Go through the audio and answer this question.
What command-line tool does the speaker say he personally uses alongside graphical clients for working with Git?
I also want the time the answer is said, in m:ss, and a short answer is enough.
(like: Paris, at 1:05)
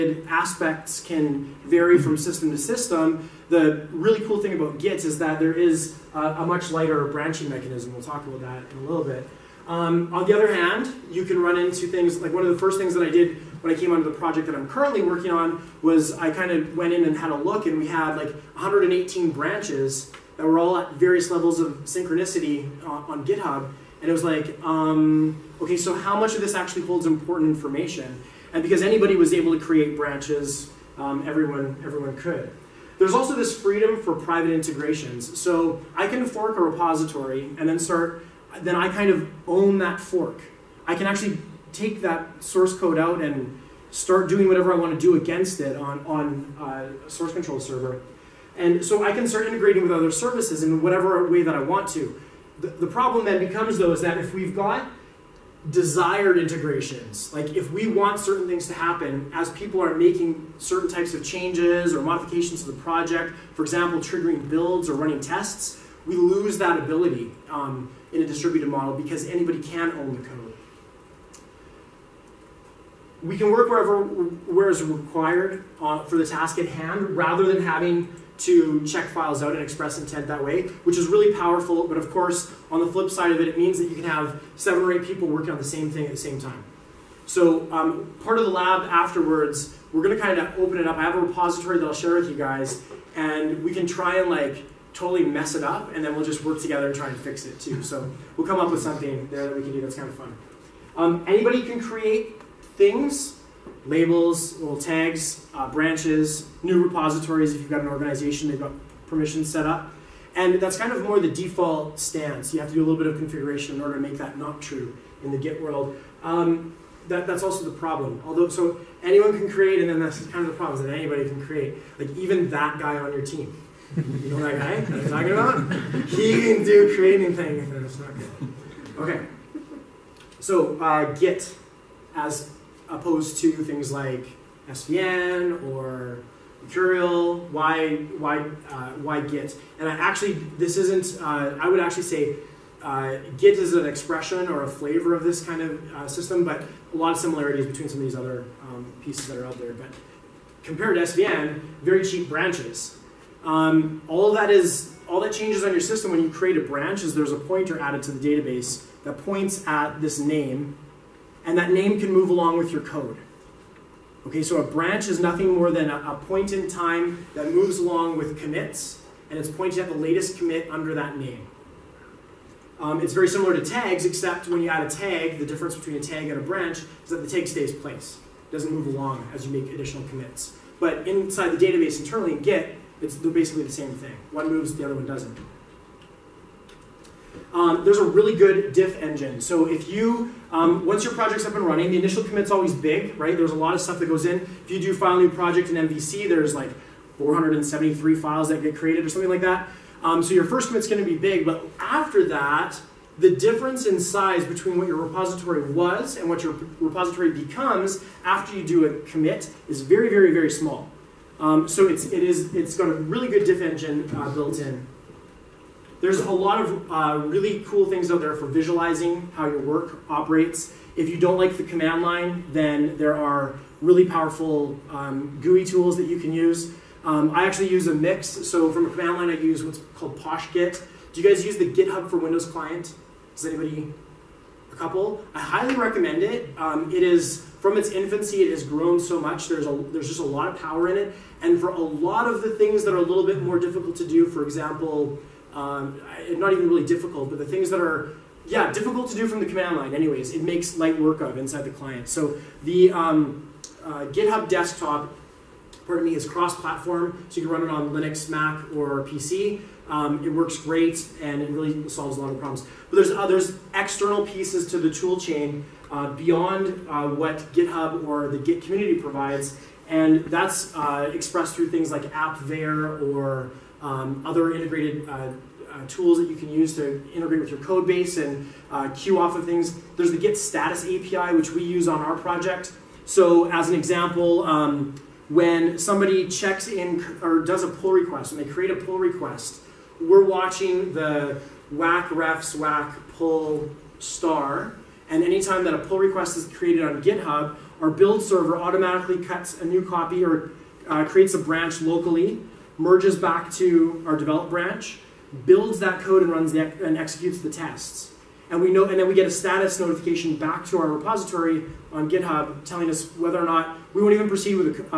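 PoshGit, at 3:50.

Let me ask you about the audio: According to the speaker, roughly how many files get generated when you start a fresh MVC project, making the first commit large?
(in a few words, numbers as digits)
473.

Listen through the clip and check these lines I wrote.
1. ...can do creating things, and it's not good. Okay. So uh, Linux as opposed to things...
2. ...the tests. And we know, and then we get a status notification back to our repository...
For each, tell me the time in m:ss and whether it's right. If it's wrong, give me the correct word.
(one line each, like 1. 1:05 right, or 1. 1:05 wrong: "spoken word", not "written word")
1. 2:06 wrong: "Git", not "Linux"
2. 5:07 right.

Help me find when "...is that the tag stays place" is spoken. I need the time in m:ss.
2:57.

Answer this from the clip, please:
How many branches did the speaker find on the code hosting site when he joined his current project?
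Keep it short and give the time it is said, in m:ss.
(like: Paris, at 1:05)
118, at 0:18.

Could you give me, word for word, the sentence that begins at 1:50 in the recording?
And that's kind of more the default stance.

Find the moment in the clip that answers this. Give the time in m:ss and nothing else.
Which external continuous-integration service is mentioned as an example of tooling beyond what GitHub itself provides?
4:32.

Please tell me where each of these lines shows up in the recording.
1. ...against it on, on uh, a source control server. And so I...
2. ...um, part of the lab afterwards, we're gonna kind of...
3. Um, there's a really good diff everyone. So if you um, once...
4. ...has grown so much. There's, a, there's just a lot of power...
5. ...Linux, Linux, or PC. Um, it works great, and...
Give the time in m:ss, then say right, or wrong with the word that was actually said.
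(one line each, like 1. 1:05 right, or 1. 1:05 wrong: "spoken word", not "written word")
1. 0:45 right
2. 1:27 right
3. 3:07 wrong: "engine", not "everyone"
4. 3:58 right
5. 4:17 wrong: "Mac", not "Linux".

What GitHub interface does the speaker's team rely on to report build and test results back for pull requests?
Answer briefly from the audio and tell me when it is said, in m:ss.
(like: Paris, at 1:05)
Git status API, at 4:40.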